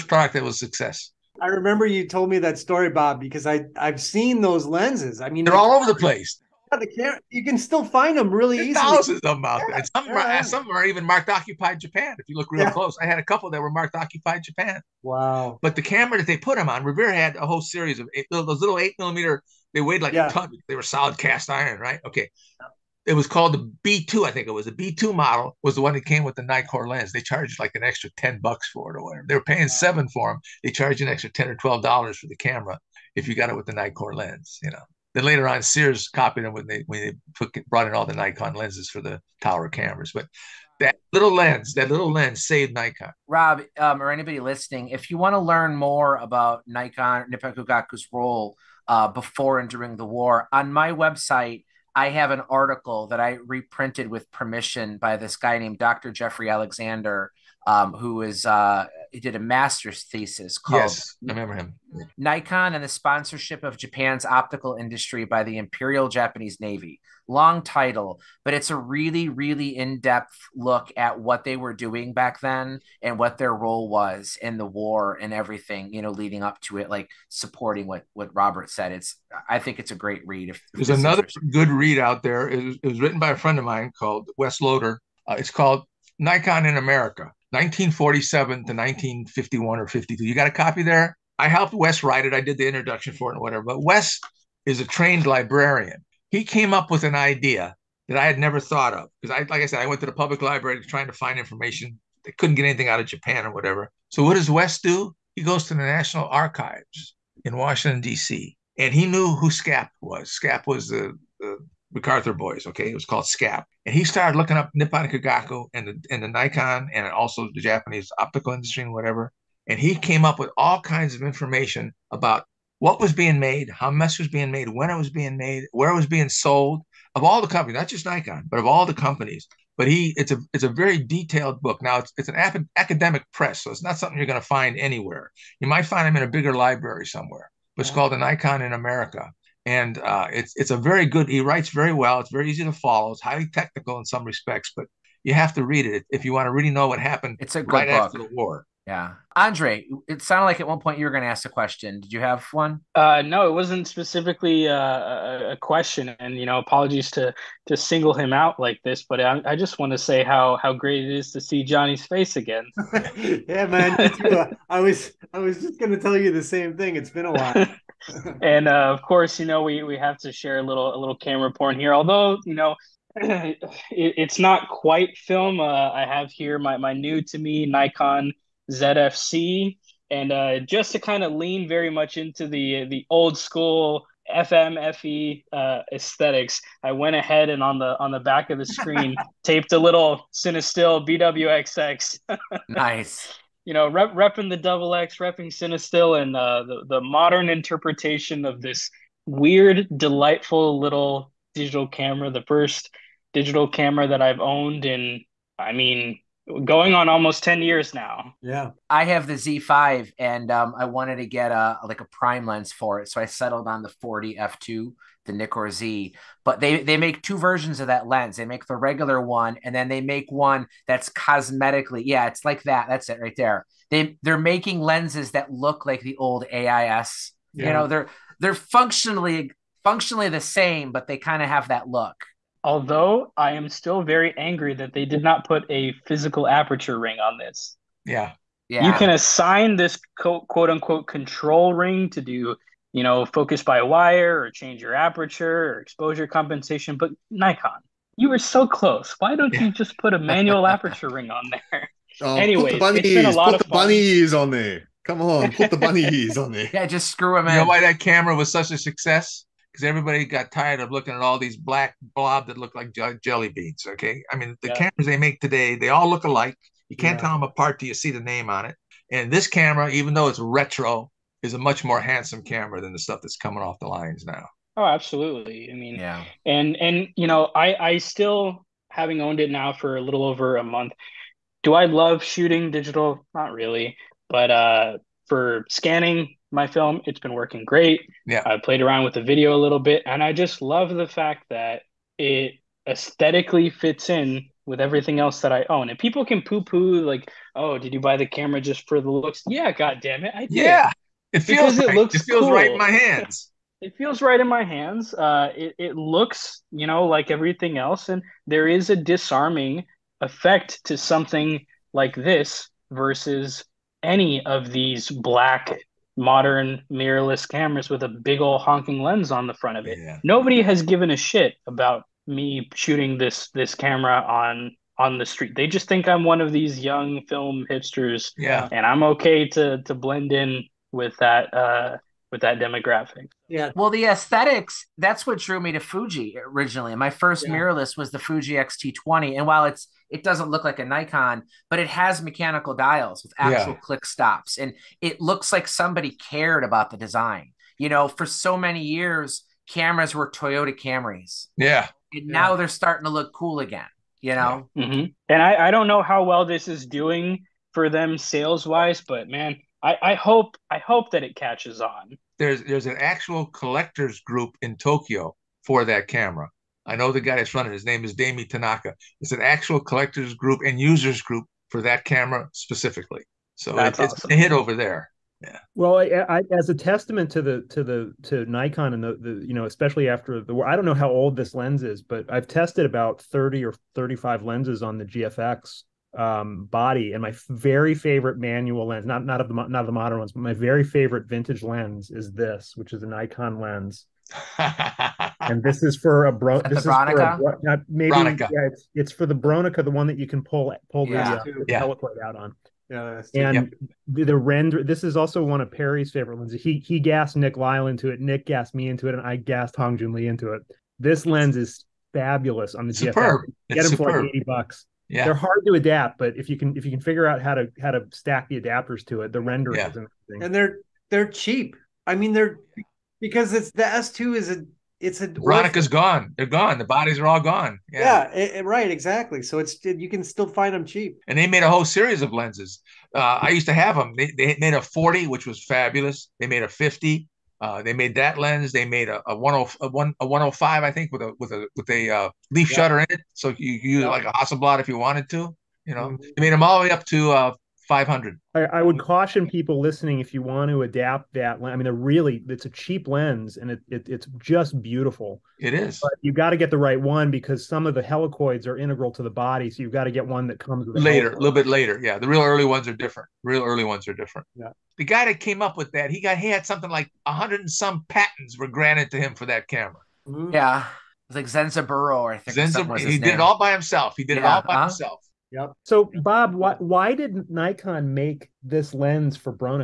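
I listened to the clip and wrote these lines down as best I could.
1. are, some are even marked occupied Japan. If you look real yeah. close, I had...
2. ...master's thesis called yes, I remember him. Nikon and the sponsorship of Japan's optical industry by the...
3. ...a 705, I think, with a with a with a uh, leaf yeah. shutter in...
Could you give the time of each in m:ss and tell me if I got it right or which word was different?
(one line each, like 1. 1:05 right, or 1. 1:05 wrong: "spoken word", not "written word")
1. 0:10 right
2. 0:59 right
3. 7:20 wrong: "105", not "705".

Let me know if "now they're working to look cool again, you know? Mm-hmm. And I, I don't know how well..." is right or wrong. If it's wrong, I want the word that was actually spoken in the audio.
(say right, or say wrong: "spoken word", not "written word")
wrong: "starting", not "working".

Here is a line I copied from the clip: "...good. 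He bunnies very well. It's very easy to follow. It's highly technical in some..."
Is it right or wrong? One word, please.
wrong.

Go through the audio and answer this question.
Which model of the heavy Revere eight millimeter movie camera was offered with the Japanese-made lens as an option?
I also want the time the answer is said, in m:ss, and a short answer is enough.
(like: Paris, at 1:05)
B2, at 0:24.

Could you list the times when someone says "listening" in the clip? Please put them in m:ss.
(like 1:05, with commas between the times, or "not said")
0:44, 7:29.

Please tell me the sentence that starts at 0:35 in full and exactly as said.
Then later on, Sears copied them when they when they put, brought in all the Nikon lenses for the tower cameras.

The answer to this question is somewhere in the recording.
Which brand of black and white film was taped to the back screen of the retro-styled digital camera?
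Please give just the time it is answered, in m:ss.
3:10.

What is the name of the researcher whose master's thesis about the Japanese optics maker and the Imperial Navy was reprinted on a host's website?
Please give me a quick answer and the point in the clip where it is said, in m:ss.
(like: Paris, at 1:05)
Jeffrey Alexander, at 0:55.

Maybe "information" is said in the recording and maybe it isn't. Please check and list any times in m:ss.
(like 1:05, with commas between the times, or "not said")
1:41, 2:01.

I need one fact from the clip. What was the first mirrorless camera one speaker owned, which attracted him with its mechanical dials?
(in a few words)
Fuji X-T20.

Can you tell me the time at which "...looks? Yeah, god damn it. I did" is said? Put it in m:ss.
4:59.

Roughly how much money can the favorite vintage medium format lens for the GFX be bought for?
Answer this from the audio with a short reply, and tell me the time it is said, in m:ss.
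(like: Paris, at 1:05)
80 dollars, at 6:54.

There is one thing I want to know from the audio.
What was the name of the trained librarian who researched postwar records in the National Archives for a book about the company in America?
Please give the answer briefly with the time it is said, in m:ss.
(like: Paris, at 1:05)
Wes Loader, at 1:24.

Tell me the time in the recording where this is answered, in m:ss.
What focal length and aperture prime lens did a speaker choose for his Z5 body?
3:34.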